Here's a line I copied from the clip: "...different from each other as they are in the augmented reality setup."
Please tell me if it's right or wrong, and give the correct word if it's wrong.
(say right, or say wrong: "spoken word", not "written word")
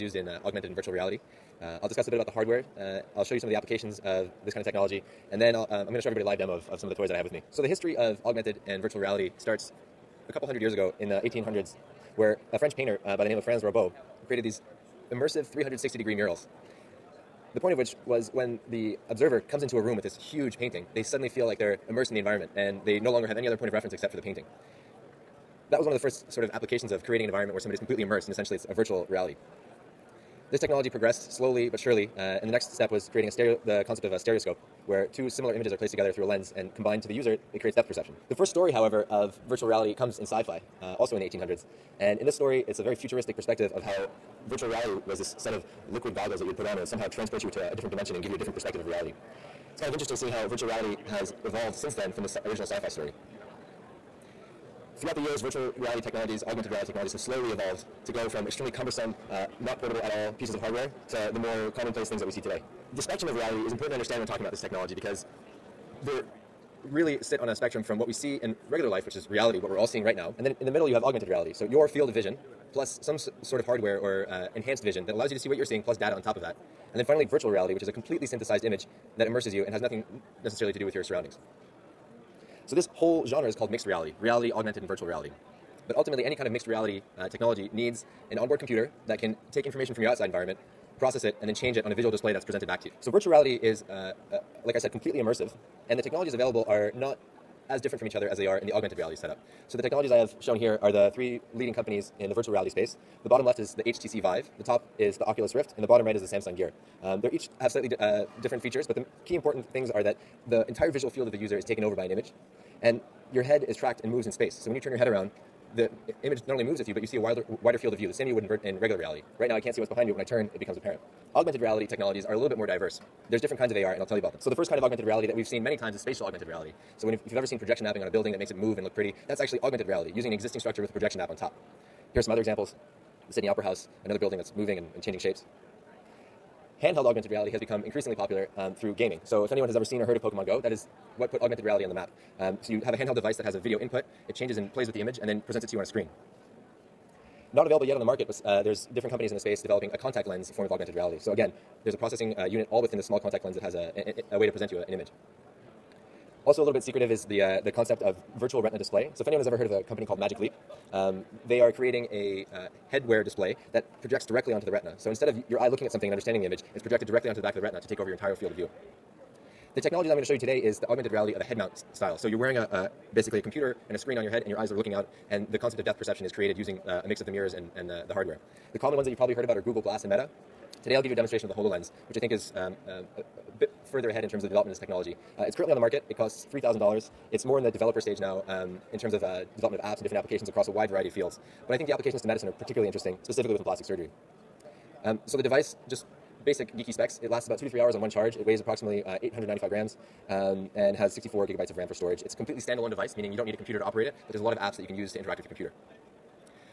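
right.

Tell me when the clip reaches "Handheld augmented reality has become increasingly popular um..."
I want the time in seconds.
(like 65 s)
136 s.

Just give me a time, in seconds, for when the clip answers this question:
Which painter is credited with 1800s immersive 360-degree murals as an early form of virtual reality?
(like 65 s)
13 s.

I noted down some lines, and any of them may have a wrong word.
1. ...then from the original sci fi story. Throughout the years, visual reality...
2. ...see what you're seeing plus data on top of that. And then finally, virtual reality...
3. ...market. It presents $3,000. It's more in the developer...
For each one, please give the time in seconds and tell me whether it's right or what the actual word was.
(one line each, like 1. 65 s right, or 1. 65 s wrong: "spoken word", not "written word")
1. 51 s wrong: "virtual", not "visual"
2. 75 s right
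3. 185 s wrong: "costs", not "presents".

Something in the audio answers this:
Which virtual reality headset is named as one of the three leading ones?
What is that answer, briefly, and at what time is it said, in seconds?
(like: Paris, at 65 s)
Samsung Gear, at 106 s.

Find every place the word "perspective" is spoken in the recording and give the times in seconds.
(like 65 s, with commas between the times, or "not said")
43 s, 48 s.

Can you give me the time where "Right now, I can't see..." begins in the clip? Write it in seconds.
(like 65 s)
119 s.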